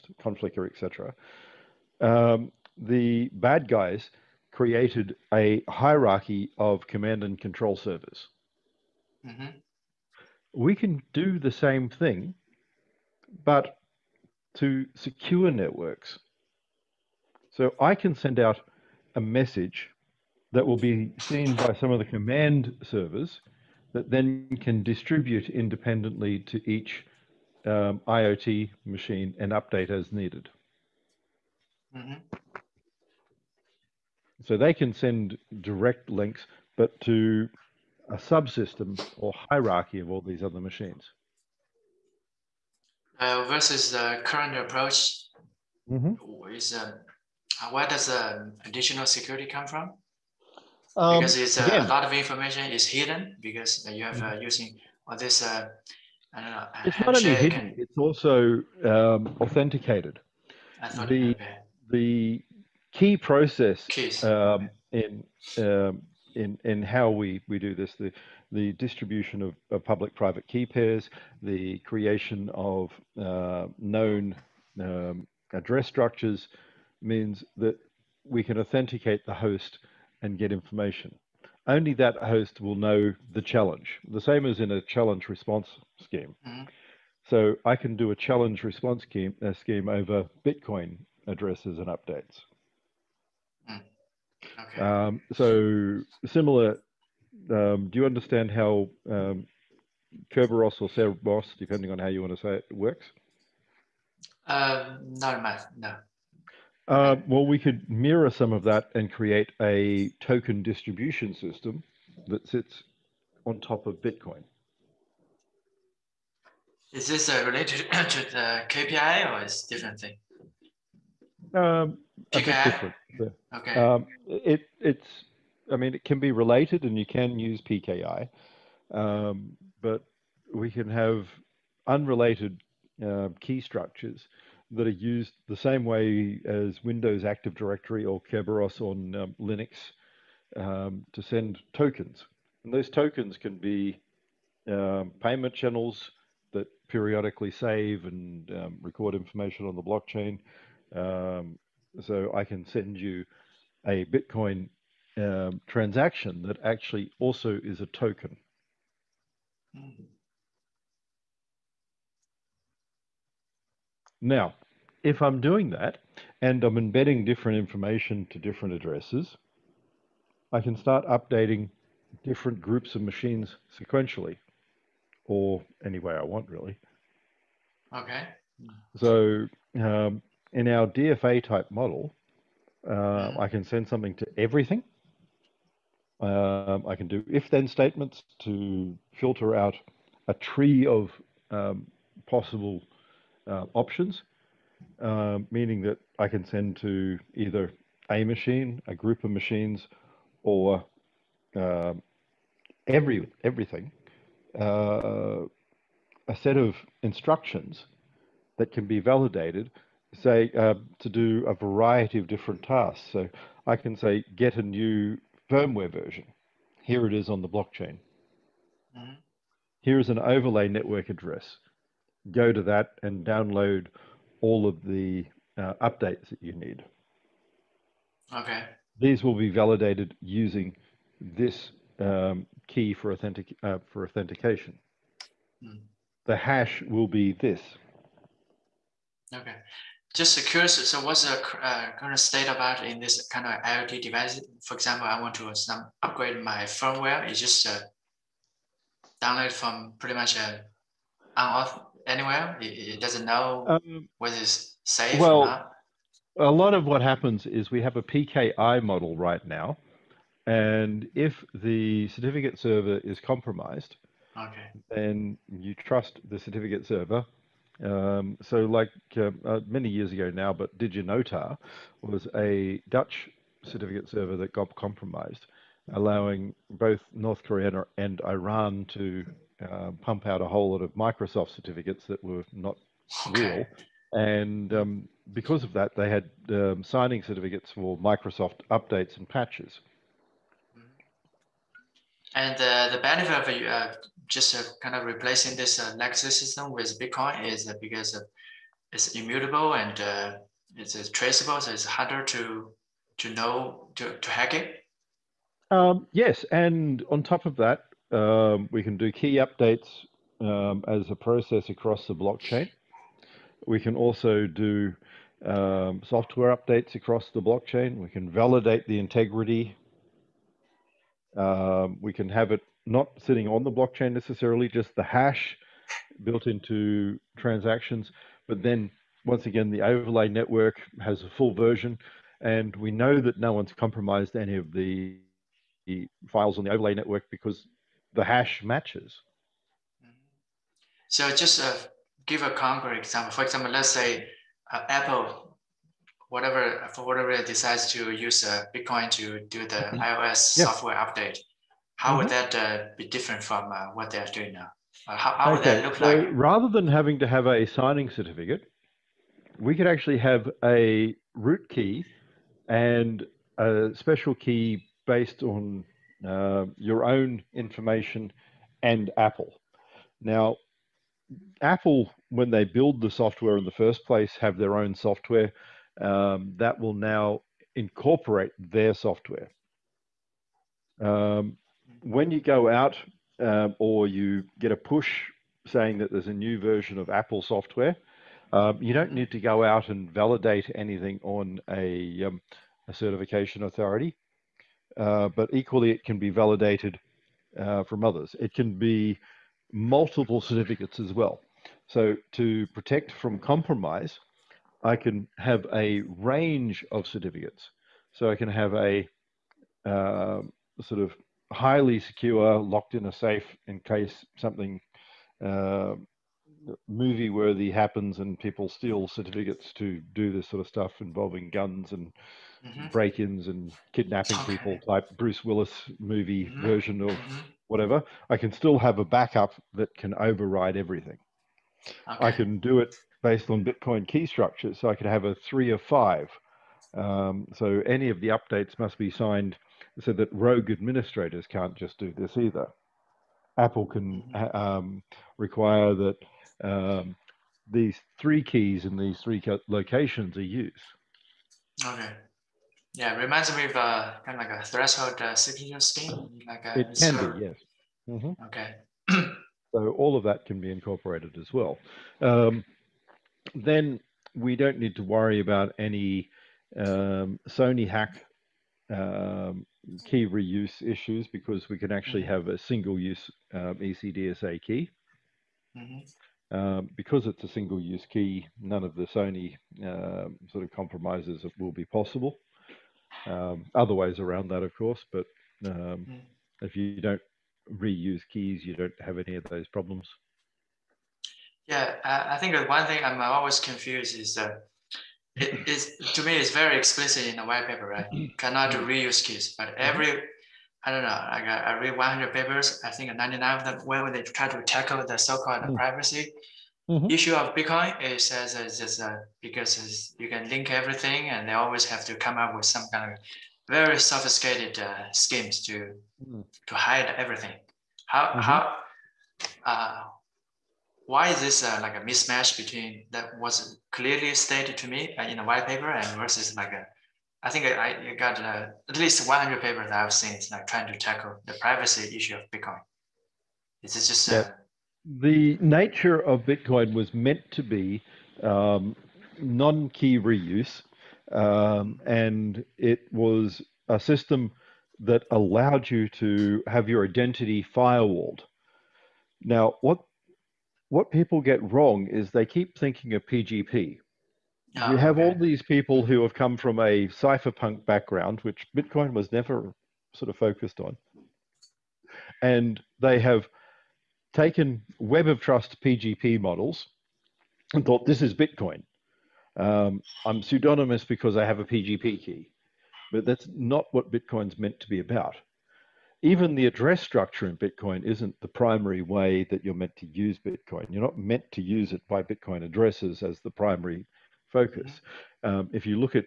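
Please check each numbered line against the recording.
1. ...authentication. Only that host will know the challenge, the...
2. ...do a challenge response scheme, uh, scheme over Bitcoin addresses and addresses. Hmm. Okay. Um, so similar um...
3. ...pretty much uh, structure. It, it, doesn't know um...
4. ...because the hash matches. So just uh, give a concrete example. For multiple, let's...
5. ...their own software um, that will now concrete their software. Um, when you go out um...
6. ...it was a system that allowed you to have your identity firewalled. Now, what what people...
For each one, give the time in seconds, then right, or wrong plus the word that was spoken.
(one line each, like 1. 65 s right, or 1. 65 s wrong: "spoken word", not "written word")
1. 80 s wrong: "information", not "authentication"
2. 87 s wrong: "updates", not "addresses"
3. 249 s wrong: "anywhere", not "structure"
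4. 337 s wrong: "example", not "multiple"
5. 374 s wrong: "incorporate", not "concrete"
6. 542 s right.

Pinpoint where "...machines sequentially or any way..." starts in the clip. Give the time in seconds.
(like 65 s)
173 s.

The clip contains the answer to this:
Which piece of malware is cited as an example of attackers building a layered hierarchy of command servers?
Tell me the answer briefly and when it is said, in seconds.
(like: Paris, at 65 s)
Conficker, at 0 s.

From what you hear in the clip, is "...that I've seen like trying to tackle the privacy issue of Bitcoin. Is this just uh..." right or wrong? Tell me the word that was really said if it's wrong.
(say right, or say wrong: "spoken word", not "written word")
right.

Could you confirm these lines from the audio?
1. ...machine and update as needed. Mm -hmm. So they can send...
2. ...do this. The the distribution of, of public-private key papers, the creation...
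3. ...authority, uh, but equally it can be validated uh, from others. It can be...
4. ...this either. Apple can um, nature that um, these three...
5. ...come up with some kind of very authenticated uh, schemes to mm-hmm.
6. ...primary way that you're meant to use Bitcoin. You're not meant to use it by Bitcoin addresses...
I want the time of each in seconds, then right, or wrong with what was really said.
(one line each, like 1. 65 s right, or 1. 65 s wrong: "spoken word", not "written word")
1. 28 s right
2. 67 s wrong: "pairs", not "papers"
3. 393 s right
4. 442 s wrong: "require", not "nature"
5. 512 s wrong: "sophisticated", not "authenticated"
6. 578 s right.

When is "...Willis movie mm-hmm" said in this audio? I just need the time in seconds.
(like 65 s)
425 s.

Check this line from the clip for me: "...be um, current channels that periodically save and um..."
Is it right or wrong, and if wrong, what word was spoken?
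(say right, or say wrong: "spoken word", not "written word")
wrong: "payment", not "current".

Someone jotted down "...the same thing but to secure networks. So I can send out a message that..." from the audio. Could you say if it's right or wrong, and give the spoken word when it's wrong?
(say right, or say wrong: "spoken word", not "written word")
right.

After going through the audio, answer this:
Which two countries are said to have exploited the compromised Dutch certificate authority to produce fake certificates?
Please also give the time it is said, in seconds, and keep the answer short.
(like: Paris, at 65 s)
North Korea and Iran, at 277 s.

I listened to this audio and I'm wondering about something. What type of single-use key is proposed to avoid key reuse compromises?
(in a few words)
ECDSA.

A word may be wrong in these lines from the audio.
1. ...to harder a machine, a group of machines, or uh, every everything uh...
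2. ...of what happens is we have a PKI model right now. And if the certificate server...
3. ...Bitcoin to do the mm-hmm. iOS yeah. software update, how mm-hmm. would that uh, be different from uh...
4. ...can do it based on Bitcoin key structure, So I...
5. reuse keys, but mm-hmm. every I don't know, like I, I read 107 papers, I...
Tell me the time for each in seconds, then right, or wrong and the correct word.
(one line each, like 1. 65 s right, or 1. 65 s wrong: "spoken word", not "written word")
1. 196 s wrong: "either", not "harder"
2. 256 s right
3. 348 s right
4. 432 s right
5. 498 s wrong: "100", not "107".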